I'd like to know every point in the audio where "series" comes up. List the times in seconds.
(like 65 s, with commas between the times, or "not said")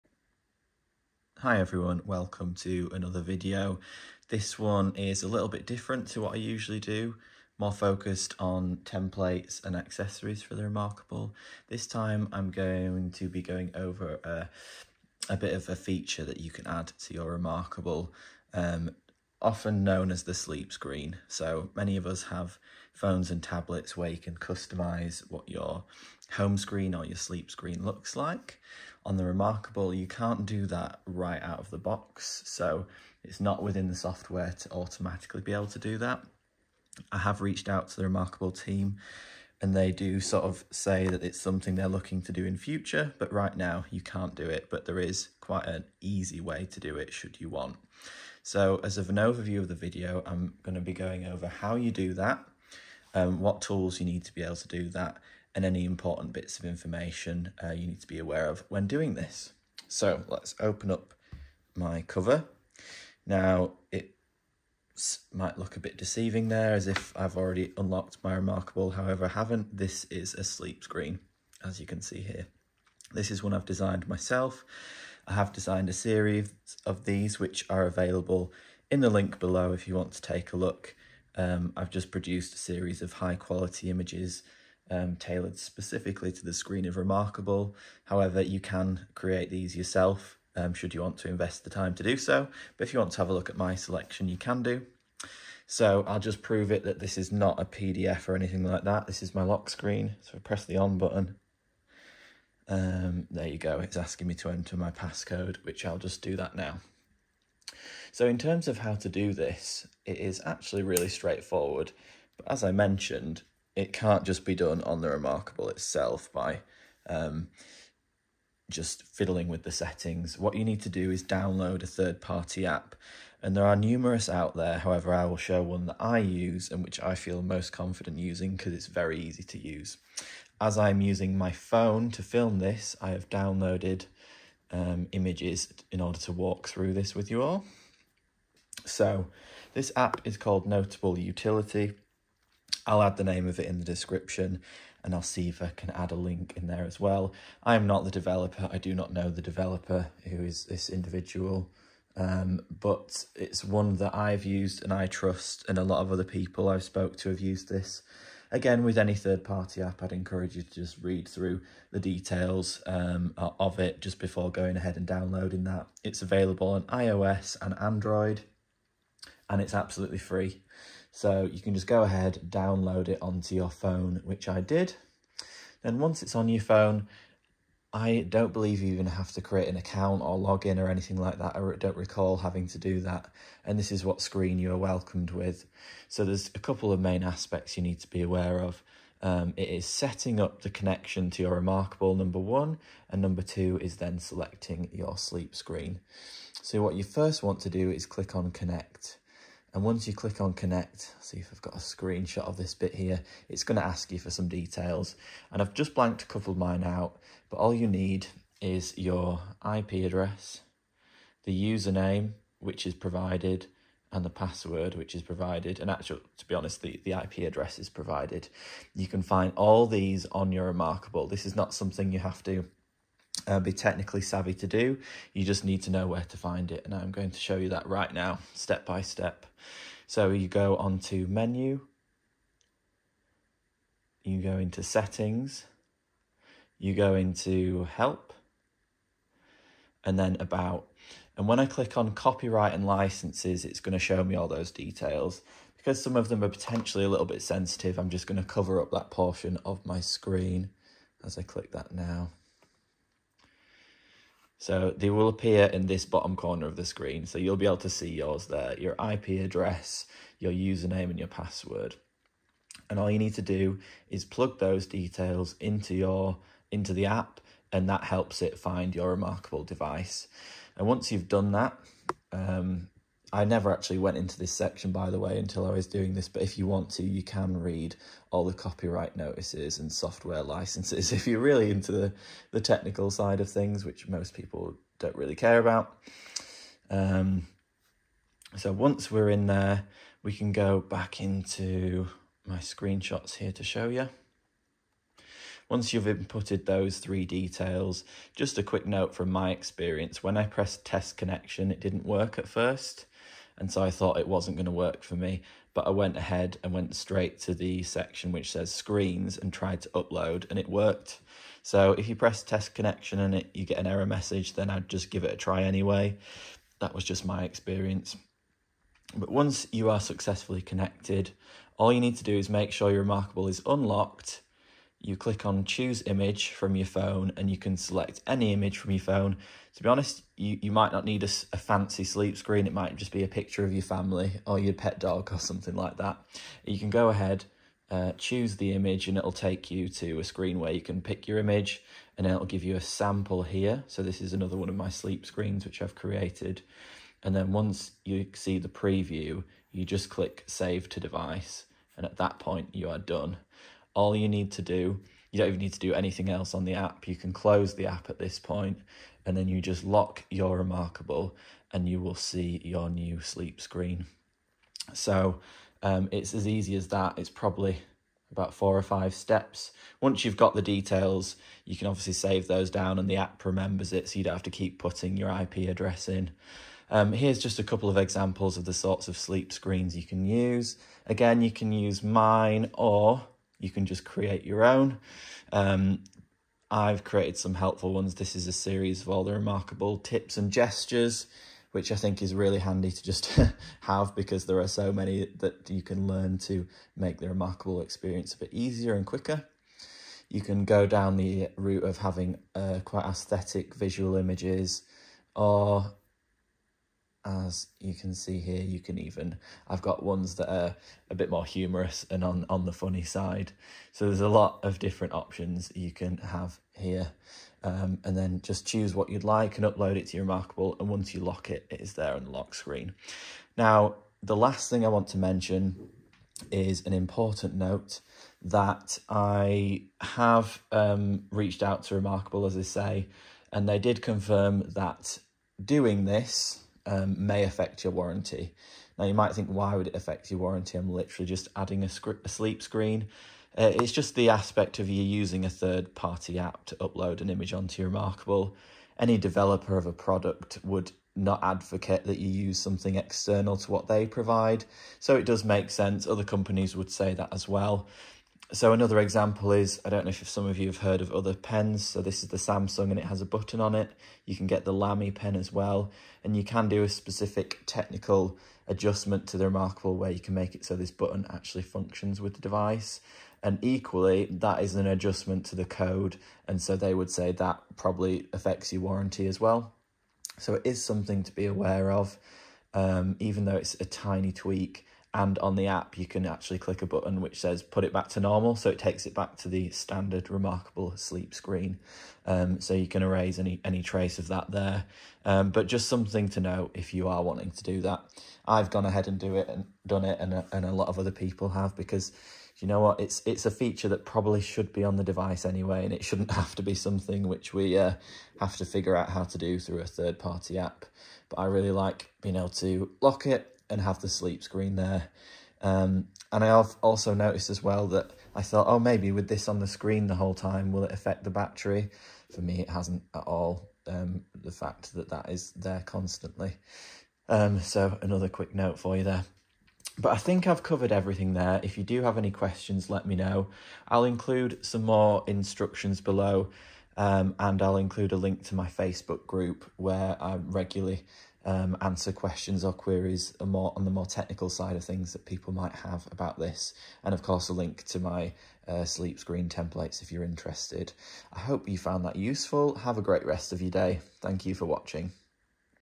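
75 s, 82 s, 388 s.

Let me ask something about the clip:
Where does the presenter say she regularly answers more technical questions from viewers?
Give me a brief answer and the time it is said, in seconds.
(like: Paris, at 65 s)
Facebook group, at 538 s.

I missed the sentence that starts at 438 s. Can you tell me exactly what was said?
Now, you might think, why would it affect your warranty?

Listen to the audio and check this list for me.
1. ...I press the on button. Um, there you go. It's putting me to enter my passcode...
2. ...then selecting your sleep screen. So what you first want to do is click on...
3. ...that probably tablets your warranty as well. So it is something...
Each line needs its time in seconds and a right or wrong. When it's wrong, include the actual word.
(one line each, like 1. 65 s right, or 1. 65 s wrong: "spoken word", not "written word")
1. 100 s wrong: "asking", not "putting"
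2. 193 s right
3. 477 s wrong: "affects", not "tablets".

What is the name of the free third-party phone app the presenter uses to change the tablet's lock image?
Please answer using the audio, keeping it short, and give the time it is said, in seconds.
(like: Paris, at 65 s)
Notable Utility, at 140 s.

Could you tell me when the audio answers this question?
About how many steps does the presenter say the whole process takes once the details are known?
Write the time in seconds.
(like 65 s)
368 s.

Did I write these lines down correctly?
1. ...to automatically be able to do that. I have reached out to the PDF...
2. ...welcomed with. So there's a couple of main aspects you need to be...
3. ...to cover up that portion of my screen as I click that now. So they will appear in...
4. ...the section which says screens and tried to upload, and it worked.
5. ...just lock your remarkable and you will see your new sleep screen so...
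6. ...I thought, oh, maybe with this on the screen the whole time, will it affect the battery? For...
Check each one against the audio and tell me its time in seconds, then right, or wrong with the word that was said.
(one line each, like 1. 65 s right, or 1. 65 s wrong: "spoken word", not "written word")
1. 34 s wrong: "Remarkable", not "PDF"
2. 184 s right
3. 248 s right
4. 307 s right
5. 359 s right
6. 518 s right.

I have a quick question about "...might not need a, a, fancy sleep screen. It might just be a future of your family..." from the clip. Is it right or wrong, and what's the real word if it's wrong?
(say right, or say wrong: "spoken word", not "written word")
wrong: "picture", not "future".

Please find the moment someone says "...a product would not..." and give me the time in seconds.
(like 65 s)
449 s.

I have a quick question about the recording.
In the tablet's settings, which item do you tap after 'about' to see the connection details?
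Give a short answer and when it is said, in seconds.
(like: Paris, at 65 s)
copyright and licenses, at 242 s.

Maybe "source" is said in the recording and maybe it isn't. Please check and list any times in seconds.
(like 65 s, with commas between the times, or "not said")
not said.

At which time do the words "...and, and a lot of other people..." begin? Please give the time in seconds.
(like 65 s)
500 s.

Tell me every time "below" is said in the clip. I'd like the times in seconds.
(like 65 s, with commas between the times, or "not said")
79 s, 536 s.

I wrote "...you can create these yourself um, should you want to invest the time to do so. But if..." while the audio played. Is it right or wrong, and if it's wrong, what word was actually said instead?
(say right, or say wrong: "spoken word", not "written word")
right.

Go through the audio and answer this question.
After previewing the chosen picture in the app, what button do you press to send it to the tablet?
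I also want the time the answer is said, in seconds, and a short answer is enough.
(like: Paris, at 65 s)
save to device, at 350 s.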